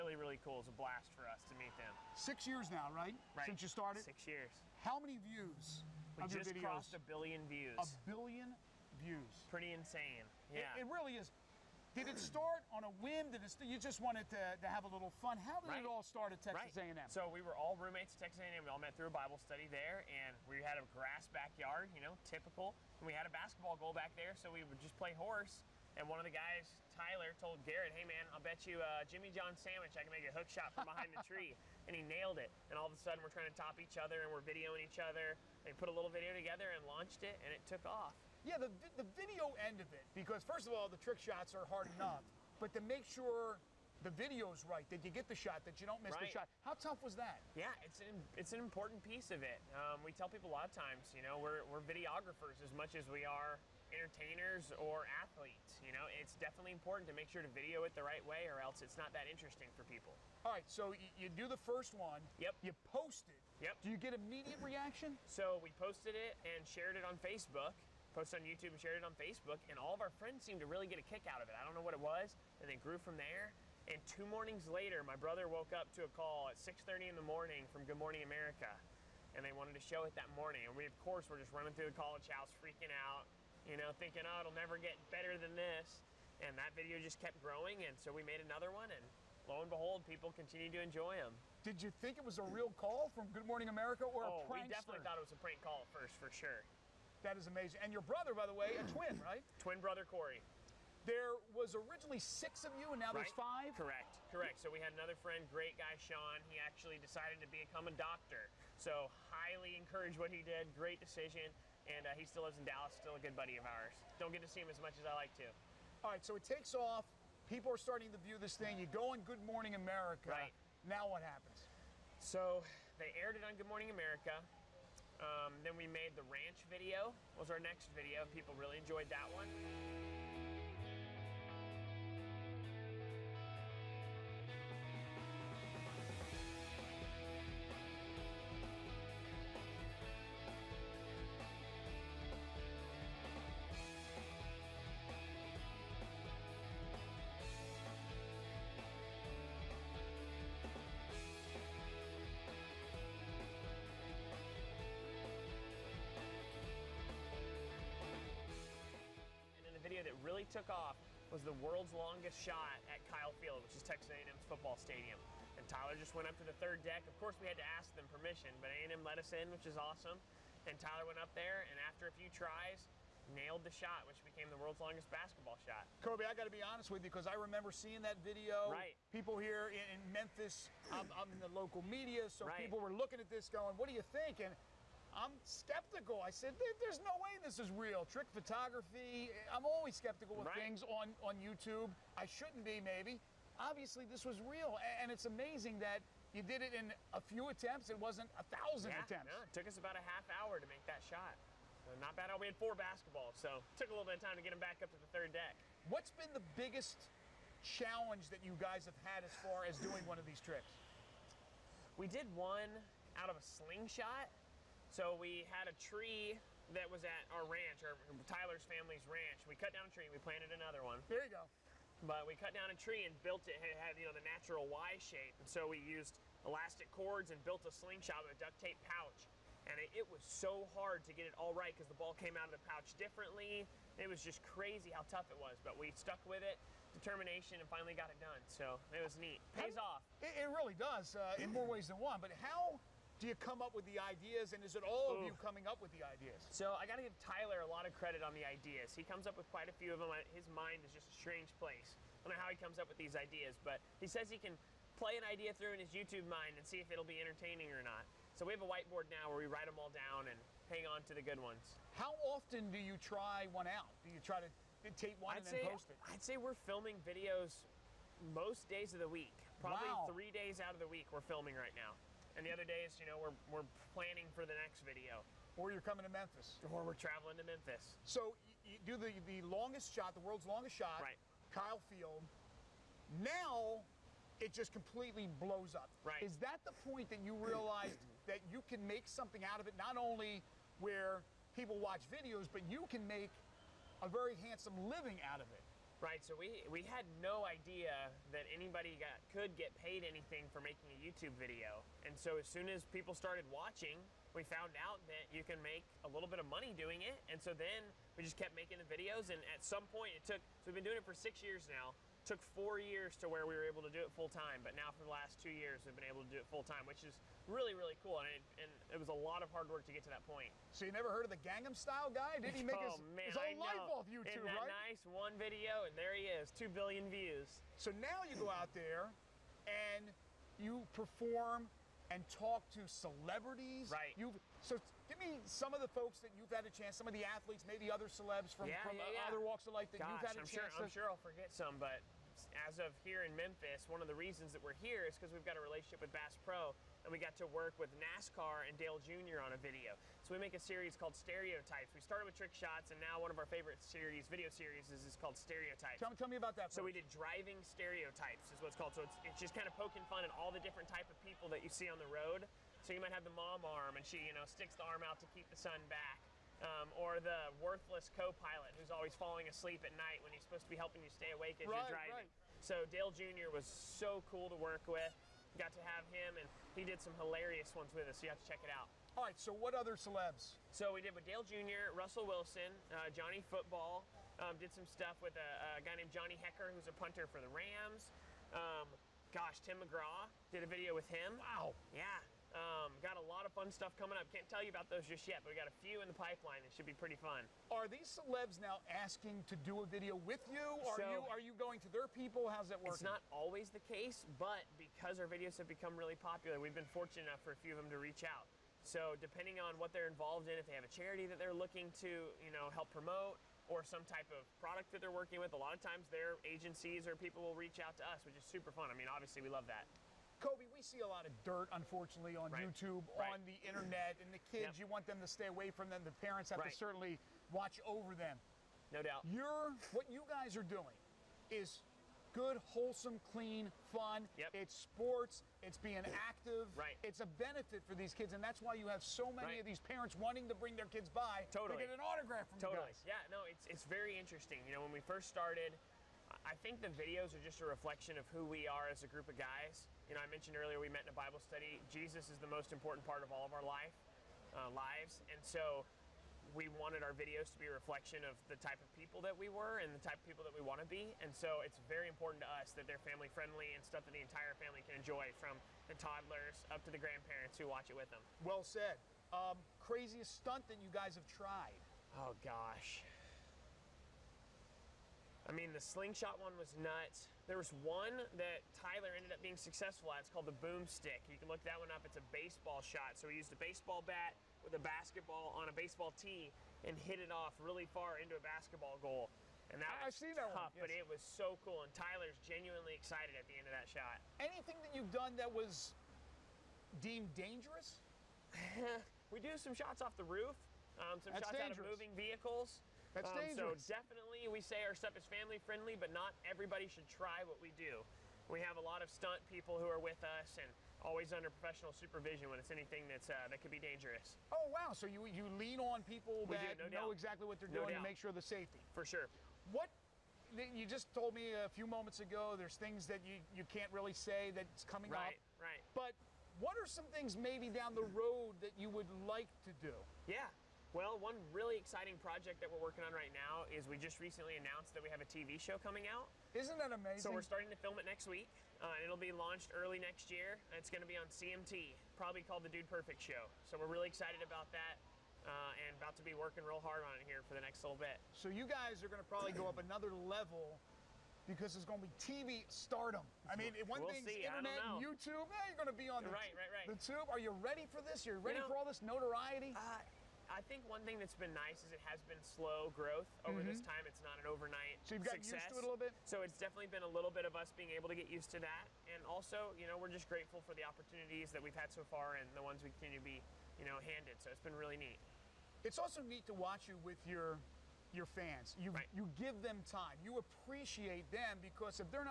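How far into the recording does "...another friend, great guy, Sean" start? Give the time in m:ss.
1:44.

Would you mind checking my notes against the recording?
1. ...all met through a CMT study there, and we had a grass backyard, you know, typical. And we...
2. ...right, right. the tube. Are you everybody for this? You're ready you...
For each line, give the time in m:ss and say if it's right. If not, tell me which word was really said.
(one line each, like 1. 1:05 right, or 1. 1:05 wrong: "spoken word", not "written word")
1. 0:18 wrong: "Bible", not "CMT"
2. 9:16 wrong: "ready", not "everybody".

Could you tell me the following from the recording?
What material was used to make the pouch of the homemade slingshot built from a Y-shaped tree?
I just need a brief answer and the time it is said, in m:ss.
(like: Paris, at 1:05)
Duct tape, at 3:48.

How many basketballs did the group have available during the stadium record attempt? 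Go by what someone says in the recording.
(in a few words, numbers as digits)
4.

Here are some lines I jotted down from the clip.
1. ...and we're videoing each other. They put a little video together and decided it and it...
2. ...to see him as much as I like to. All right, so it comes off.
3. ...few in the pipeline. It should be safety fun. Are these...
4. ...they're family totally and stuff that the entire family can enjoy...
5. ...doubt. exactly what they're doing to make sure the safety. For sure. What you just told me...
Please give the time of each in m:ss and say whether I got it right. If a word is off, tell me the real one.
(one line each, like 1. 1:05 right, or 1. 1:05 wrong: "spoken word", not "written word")
1. 0:34 wrong: "launched", not "decided"
2. 1:54 wrong: "takes", not "comes"
3. 6:35 wrong: "pretty", not "safety"
4. 7:42 wrong: "friendly", not "totally"
5. 8:37 right.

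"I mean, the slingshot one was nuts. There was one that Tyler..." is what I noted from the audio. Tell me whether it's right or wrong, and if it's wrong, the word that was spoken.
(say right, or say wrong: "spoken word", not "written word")
right.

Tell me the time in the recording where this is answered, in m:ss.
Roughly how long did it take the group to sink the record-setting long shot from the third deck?
3:19.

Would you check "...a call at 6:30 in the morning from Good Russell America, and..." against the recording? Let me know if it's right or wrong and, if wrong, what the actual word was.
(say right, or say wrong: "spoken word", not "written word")
wrong: "Morning", not "Russell".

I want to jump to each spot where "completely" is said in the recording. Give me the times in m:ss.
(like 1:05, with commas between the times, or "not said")
4:44.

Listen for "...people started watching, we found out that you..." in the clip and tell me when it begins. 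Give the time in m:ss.
5:02.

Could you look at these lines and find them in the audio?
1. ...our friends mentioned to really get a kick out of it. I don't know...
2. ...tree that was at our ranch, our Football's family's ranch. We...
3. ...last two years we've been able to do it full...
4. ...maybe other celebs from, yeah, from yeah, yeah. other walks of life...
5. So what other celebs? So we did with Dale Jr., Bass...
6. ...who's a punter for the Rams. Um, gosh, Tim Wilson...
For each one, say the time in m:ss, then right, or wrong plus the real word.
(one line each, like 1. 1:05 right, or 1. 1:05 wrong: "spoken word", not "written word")
1. 1:10 wrong: "seemed", not "mentioned"
2. 3:35 wrong: "Tyler", not "Football"
3. 5:15 right
4. 5:37 right
5. 6:19 wrong: "Russell", not "Bass"
6. 6:26 wrong: "McGraw", not "Wilson".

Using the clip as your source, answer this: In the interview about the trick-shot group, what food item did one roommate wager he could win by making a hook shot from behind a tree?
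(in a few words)
Jimmy John sandwich.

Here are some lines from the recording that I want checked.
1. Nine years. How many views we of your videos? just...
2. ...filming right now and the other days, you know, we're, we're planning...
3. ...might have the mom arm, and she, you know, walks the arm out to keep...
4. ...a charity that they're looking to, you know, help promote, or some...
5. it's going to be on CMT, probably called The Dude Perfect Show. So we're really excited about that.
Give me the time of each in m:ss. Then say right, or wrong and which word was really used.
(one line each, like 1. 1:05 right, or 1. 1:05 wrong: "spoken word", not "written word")
1. 0:04 wrong: "Six", not "Nine"
2. 4:31 right
3. 6:02 wrong: "sticks", not "walks"
4. 6:50 right
5. 9:00 right.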